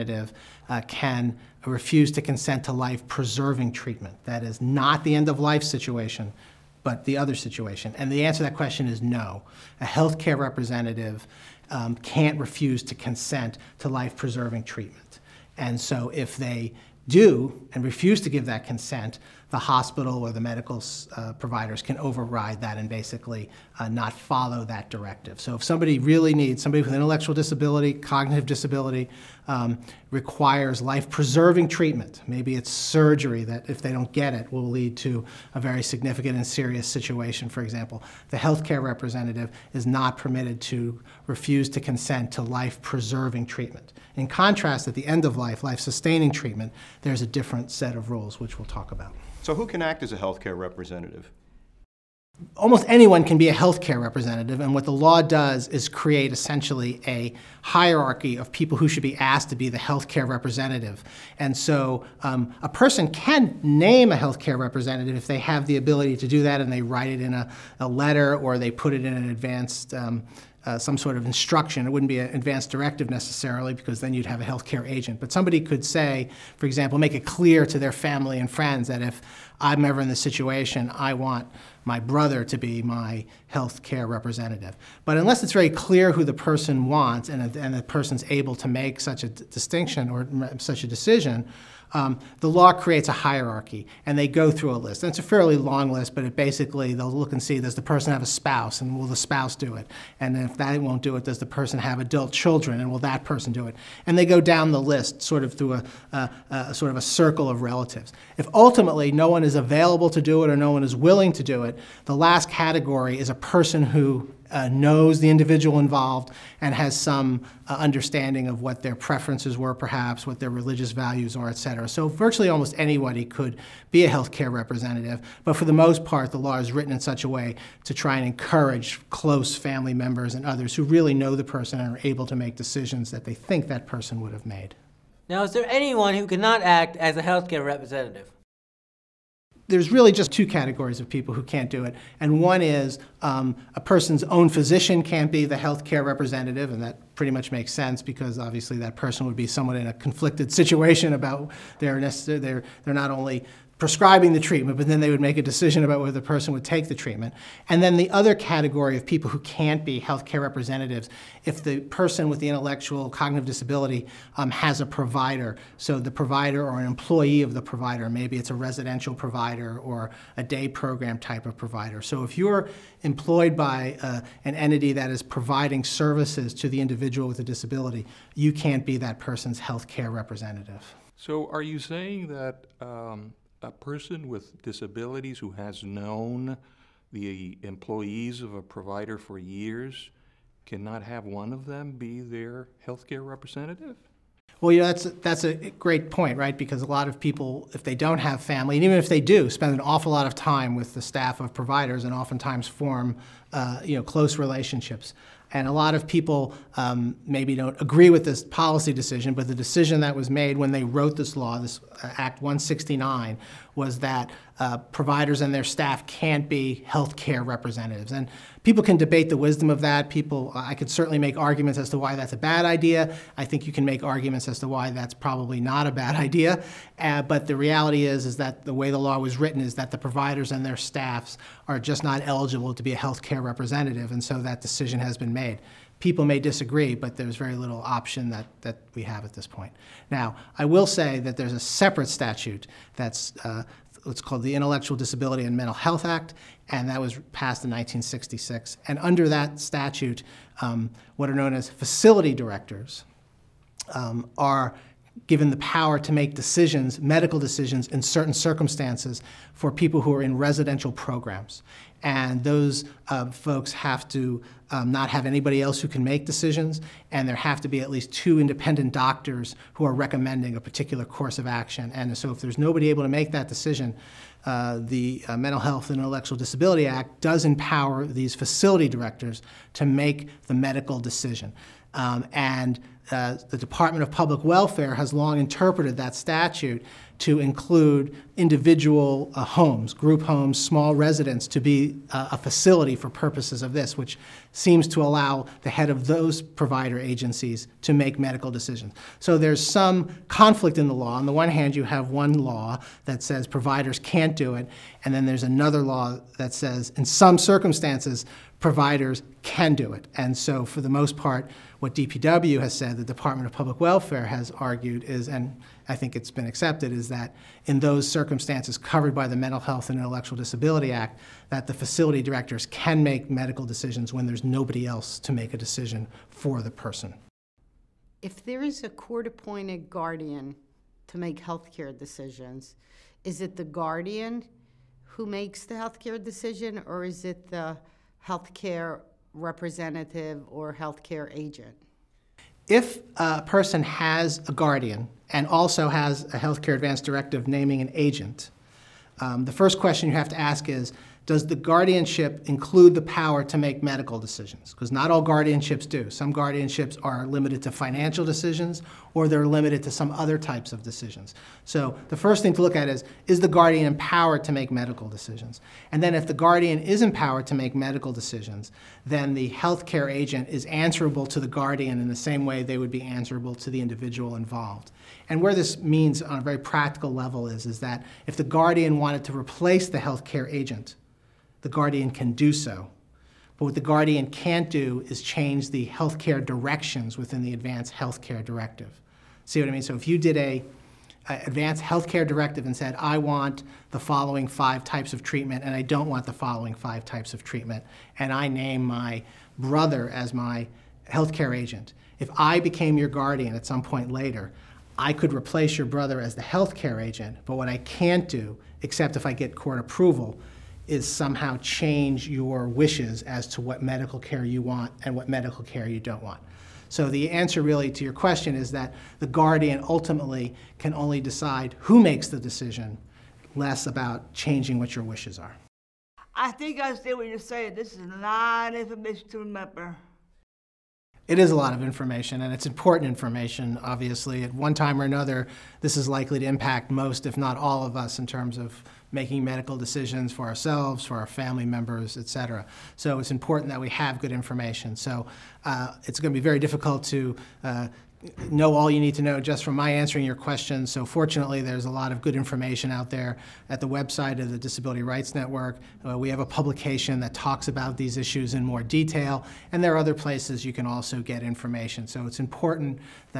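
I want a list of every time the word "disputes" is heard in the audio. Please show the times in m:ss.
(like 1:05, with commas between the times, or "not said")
not said.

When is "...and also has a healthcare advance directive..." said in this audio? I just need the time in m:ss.
5:45.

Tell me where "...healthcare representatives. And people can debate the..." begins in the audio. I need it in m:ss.
3:36.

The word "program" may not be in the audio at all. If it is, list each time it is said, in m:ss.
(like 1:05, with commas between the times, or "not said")
2:50, 4:20.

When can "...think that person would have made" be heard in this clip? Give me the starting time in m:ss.
2:13.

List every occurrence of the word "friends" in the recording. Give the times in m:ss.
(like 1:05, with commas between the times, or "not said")
1:18.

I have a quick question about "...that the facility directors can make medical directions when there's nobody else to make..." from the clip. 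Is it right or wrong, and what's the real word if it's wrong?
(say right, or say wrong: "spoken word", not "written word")
wrong: "decisions", not "directions".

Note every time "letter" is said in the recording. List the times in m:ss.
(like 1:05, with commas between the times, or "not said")
1:07.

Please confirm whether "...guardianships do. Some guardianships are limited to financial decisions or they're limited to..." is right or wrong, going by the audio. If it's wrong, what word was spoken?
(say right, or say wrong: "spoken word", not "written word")
right.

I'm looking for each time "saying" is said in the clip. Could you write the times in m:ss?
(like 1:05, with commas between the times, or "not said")
3:01, 7:07.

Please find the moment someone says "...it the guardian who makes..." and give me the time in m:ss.
5:33.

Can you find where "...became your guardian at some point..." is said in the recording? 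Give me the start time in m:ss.
6:42.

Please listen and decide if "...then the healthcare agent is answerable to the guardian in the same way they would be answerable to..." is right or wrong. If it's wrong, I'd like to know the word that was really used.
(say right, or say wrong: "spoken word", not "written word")
right.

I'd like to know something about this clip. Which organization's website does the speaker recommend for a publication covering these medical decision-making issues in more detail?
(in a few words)
Disability Rights Network.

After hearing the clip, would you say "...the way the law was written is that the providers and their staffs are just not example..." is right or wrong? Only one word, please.
wrong.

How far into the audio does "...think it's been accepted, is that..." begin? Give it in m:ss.
5:15.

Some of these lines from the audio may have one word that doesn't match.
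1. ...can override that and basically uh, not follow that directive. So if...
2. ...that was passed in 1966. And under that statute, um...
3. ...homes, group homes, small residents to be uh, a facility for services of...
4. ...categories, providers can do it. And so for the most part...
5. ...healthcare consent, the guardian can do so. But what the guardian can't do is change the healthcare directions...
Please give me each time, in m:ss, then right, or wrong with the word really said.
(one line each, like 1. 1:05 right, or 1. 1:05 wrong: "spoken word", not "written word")
1. 0:21 right
2. 4:06 right
3. 4:49 wrong: "purposes", not "services"
4. 5:07 wrong: "circumstances", not "categories"
5. 6:19 wrong: "agent", not "consent".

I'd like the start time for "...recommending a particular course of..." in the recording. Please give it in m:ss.
4:29.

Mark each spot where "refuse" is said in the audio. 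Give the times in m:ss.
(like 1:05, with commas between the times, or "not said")
0:01, 0:12, 0:17, 0:41.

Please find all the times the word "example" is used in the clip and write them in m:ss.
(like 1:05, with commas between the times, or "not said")
0:37, 1:16.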